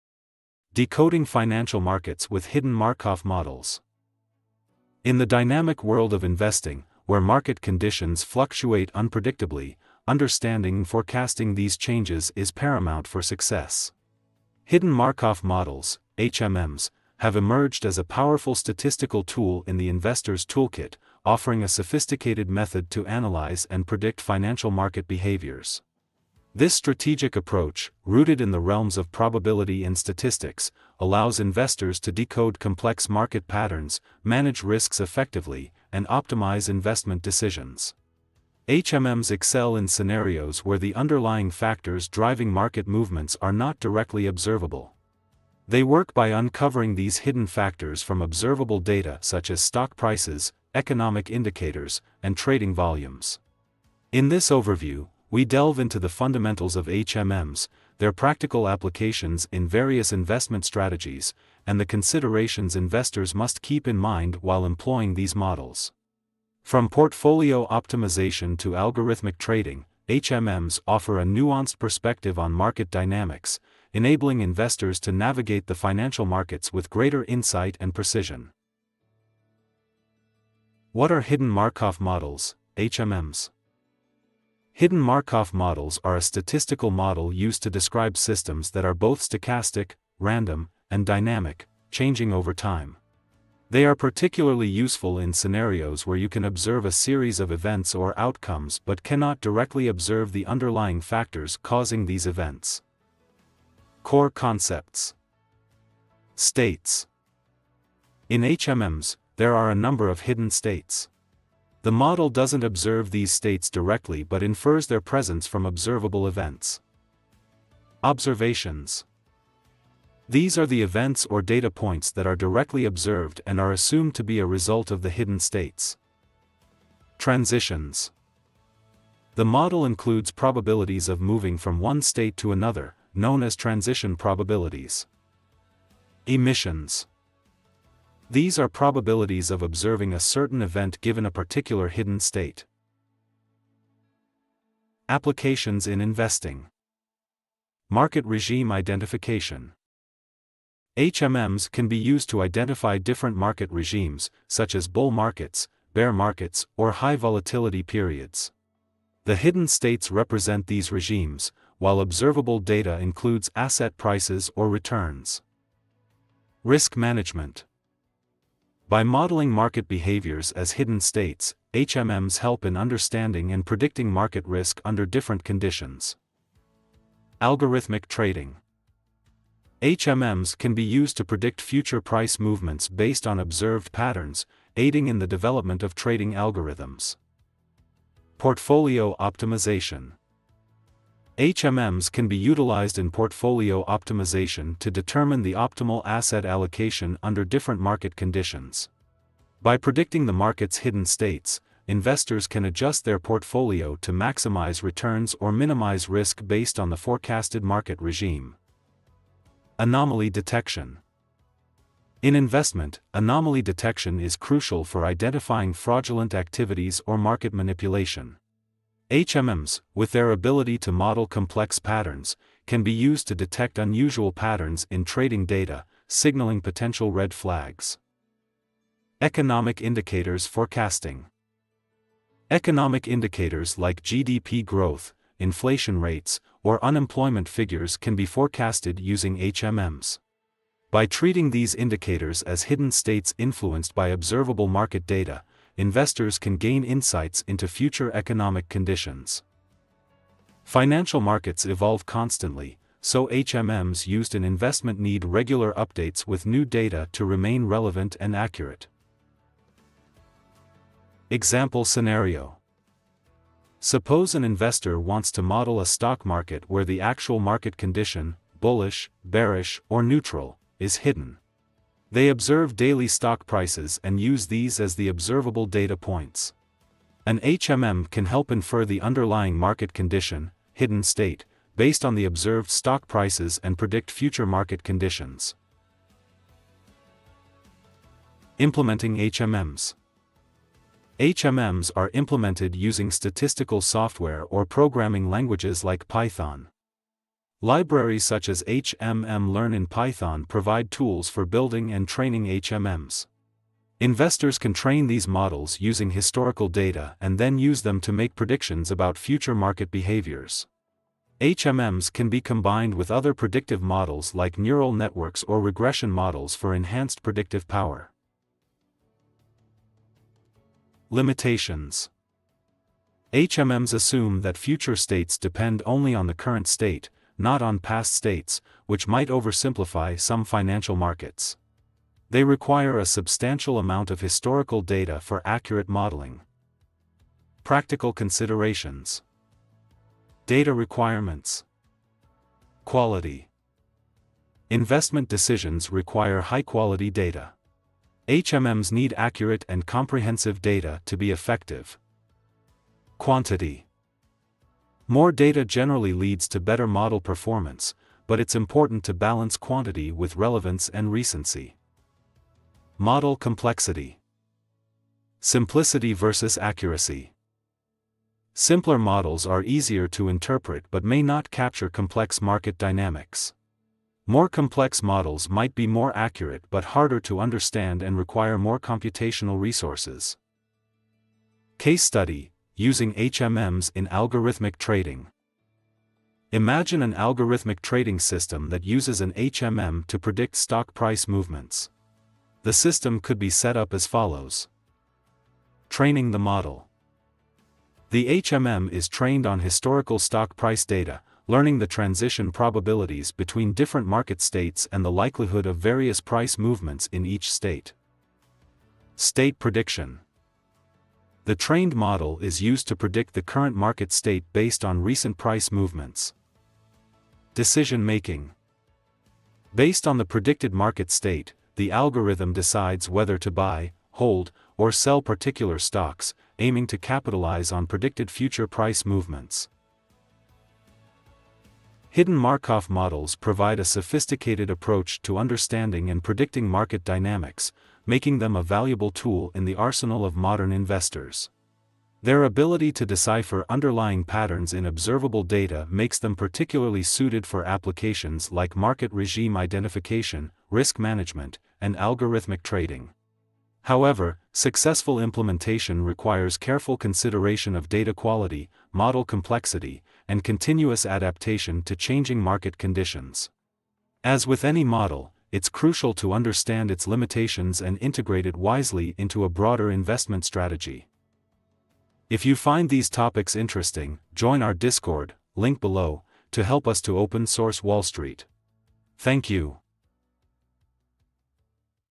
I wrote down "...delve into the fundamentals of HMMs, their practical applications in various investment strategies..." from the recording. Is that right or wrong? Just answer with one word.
right.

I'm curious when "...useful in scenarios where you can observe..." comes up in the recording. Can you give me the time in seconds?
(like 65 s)
94 s.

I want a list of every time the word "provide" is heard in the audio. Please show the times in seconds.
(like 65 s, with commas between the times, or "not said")
300 s, 433 s.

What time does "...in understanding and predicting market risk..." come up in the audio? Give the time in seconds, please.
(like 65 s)
172 s.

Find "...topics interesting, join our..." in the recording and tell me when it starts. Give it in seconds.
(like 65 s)
473 s.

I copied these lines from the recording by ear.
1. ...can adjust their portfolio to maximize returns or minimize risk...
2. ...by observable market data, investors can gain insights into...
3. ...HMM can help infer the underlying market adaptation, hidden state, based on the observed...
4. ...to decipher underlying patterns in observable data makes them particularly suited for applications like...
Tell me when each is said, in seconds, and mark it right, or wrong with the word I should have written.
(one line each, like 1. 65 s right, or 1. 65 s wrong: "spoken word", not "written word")
1. 202 s right
2. 243 s right
3. 277 s wrong: "condition", not "adaptation"
4. 442 s right.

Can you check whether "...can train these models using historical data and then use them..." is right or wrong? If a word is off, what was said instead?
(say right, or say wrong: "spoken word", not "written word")
right.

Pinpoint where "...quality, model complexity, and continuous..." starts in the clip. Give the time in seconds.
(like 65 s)
458 s.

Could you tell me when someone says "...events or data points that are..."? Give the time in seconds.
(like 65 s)
120 s.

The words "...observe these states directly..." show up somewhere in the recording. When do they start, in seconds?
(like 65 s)
112 s.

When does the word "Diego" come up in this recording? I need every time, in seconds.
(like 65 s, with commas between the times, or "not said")
not said.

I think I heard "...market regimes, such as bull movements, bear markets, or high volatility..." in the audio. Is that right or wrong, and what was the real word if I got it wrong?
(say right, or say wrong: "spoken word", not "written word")
wrong: "markets", not "movements".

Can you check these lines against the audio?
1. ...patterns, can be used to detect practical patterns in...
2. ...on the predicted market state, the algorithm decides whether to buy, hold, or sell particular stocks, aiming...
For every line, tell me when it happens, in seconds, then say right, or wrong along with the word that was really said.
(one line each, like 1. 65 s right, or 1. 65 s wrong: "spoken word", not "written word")
1. 221 s wrong: "unusual", not "practical"
2. 420 s right.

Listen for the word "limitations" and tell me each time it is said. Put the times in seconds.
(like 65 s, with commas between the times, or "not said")
321 s, 467 s.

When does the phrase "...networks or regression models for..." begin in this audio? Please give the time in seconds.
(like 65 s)
314 s.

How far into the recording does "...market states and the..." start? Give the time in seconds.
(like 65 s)
404 s.